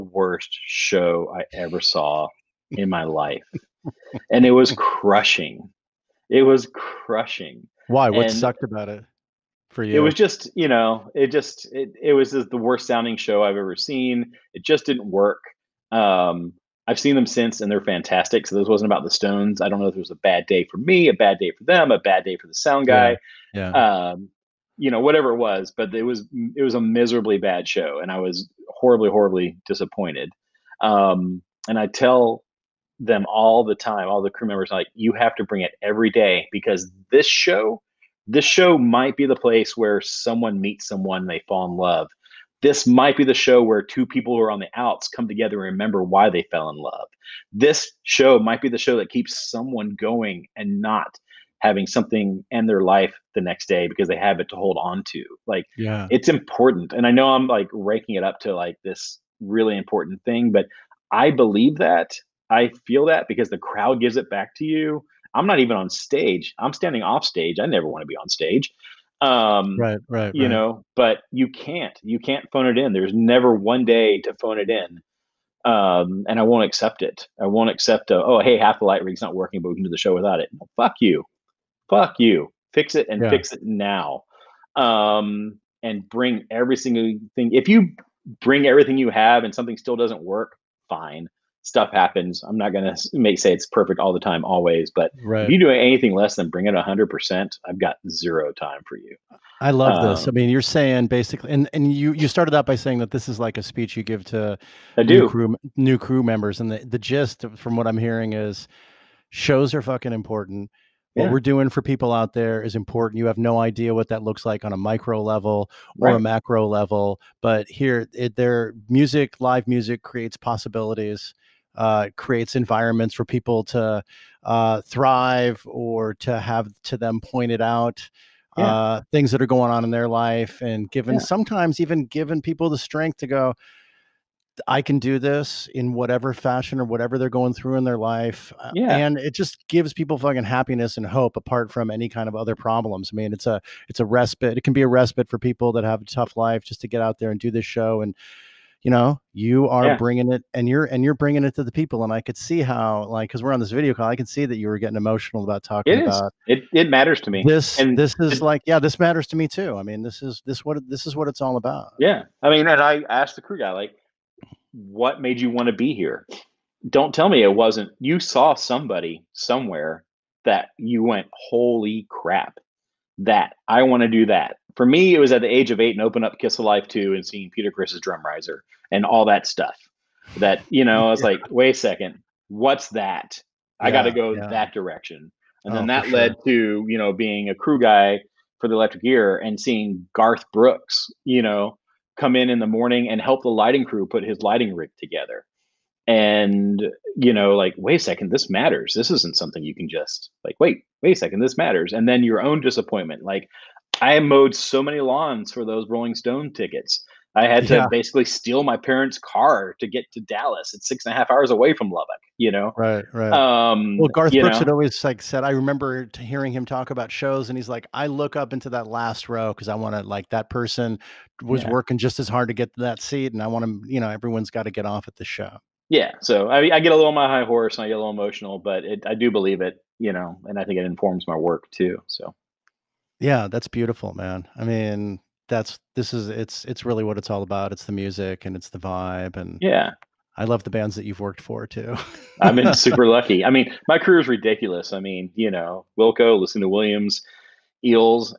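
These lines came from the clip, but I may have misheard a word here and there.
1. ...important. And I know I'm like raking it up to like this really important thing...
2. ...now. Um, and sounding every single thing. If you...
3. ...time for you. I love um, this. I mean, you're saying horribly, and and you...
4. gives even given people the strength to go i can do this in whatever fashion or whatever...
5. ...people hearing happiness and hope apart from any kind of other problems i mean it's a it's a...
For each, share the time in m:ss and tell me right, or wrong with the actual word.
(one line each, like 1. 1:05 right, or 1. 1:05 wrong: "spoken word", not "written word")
1. 0:56 right
2. 1:23 wrong: "bring", not "sounding"
3. 1:38 wrong: "basically", not "horribly"
4. 2:11 wrong: "sometimes", not "gives"
5. 2:19 wrong: "fucking", not "hearing".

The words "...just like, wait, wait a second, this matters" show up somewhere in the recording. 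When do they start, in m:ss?
3:19.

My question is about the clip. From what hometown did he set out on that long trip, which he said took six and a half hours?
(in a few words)
Lubbock.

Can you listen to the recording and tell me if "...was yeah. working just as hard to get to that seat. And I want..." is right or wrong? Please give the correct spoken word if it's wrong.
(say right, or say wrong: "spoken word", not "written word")
right.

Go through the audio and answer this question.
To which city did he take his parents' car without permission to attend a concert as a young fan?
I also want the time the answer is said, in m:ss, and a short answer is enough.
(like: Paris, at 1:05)
Dallas, at 3:30.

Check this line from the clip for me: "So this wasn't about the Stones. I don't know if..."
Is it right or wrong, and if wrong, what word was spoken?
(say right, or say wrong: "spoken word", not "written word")
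right.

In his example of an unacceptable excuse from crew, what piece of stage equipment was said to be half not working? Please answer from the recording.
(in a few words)
light rig.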